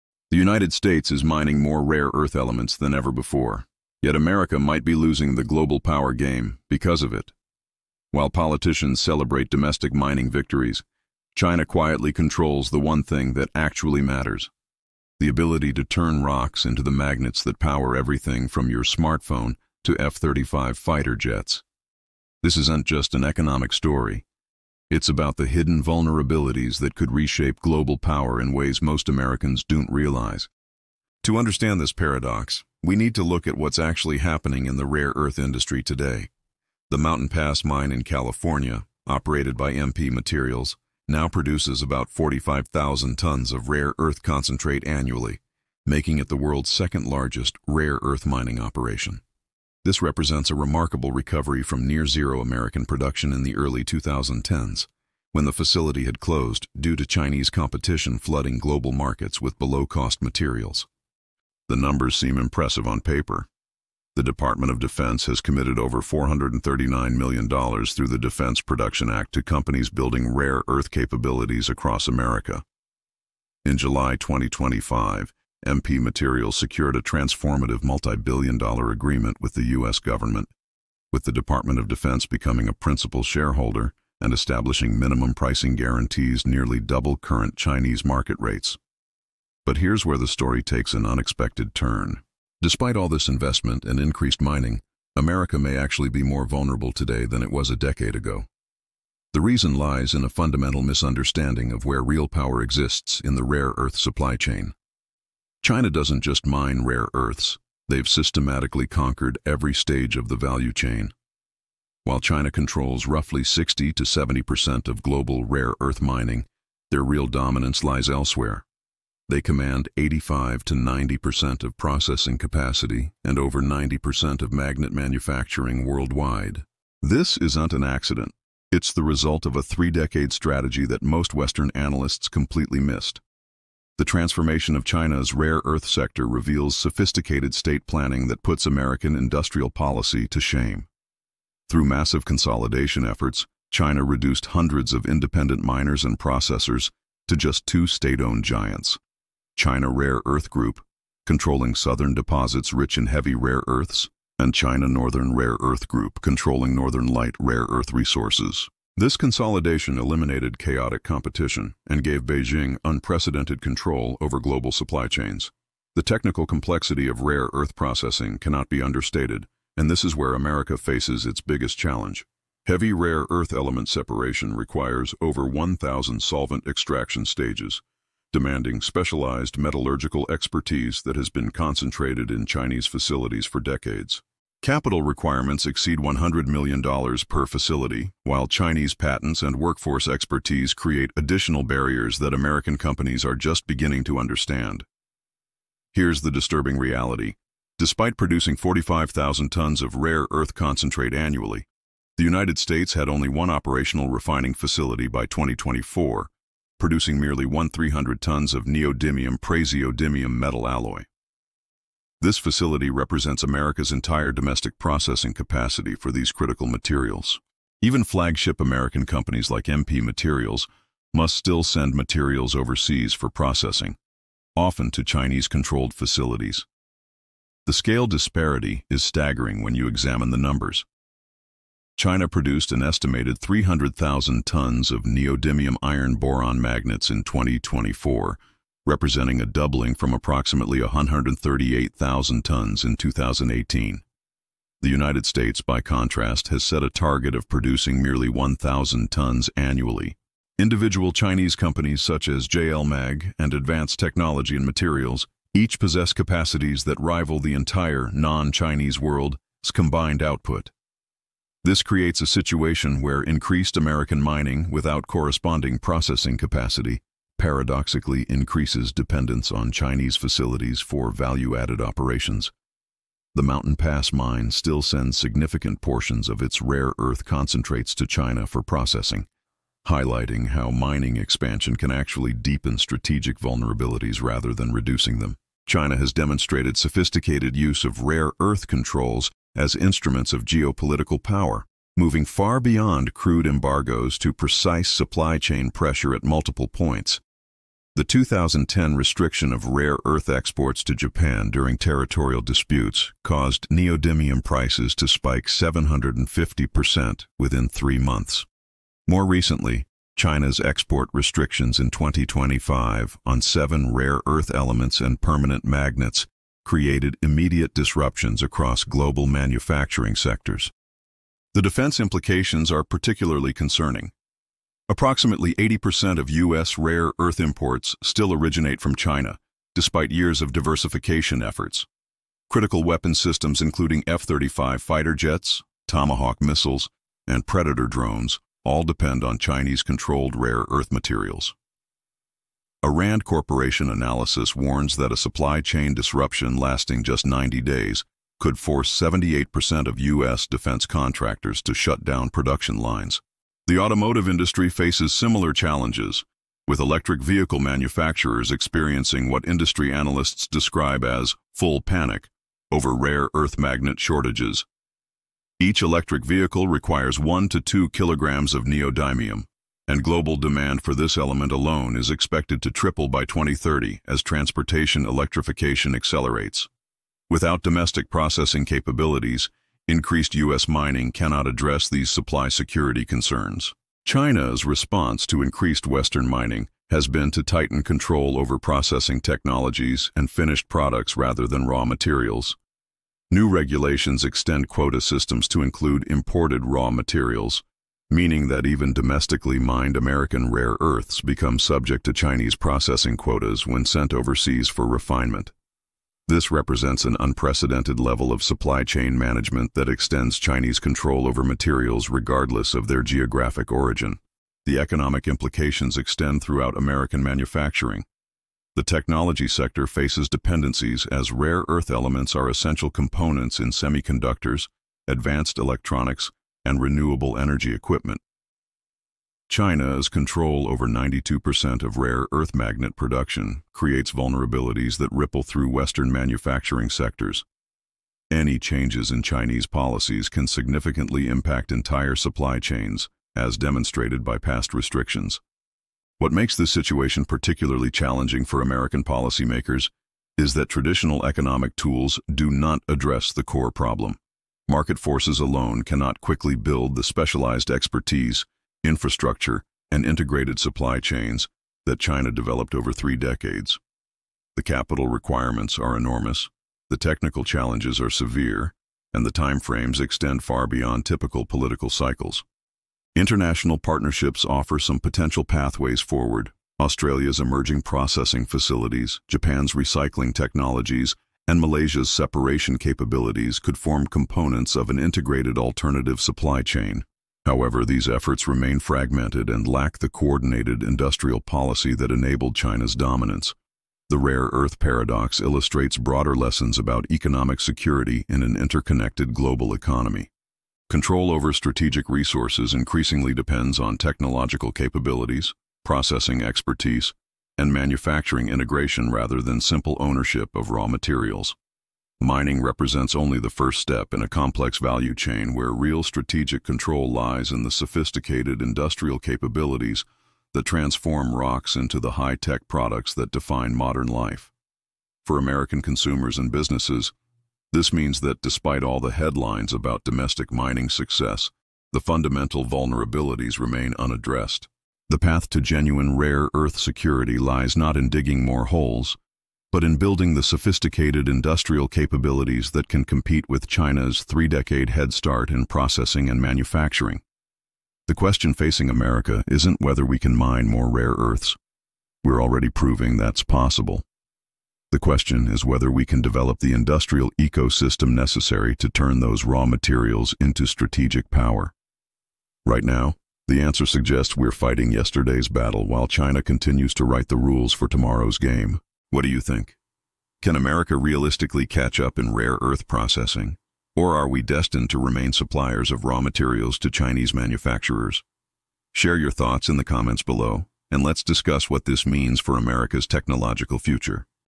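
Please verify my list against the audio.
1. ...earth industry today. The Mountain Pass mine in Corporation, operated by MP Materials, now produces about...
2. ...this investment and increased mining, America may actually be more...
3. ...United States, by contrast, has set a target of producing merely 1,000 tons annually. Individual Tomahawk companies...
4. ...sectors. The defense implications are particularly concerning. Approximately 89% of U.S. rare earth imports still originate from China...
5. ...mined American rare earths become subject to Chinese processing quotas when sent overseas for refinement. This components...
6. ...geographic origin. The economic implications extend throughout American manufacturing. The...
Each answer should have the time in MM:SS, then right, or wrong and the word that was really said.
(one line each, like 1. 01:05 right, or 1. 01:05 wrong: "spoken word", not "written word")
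1. 00:35 wrong: "California", not "Corporation"
2. 01:33 right
3. 04:04 wrong: "Chinese", not "Tomahawk"
4. 05:20 wrong: "80", not "89"
5. 06:39 wrong: "represents", not "components"
6. 06:53 right.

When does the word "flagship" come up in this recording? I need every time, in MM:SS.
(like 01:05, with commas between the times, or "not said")
03:38.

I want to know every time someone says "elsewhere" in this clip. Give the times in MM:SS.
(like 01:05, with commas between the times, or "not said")
01:58.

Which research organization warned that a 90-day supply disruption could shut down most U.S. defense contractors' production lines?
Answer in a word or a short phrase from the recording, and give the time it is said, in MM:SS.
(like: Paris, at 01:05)
RAND Corporation, at 05:42.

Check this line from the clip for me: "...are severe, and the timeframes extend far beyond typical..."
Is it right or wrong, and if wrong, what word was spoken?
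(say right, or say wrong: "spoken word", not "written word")
right.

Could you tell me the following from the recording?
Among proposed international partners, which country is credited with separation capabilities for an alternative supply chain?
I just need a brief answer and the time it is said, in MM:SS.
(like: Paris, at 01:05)
Malaysia, at 08:01.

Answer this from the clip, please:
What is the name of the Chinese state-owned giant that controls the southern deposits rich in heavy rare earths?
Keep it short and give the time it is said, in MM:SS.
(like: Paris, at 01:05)
China Rare Earth Group, at 02:29.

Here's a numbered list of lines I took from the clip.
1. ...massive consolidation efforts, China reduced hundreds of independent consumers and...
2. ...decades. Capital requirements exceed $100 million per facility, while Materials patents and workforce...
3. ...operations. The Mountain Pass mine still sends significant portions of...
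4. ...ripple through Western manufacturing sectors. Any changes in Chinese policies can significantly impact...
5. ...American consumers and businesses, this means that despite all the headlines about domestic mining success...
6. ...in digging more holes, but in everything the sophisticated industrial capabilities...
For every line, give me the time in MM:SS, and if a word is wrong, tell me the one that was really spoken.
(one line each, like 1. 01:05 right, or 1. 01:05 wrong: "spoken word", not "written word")
1. 02:21 wrong: "miners", not "consumers"
2. 03:03 wrong: "Chinese", not "Materials"
3. 04:31 right
4. 07:15 right
5. 08:45 right
6. 08:57 wrong: "building", not "everything".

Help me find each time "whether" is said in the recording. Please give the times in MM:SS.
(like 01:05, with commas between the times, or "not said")
09:09, 09:15.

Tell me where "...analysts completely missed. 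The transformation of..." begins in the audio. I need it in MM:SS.
02:11.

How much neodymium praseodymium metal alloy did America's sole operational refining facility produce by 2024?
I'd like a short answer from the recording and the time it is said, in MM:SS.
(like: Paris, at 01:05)
1,300 tons, at 03:27.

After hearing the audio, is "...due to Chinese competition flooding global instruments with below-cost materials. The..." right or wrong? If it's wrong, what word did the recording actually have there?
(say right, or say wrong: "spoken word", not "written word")
wrong: "markets", not "instruments".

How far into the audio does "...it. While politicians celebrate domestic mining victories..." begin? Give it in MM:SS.
00:07.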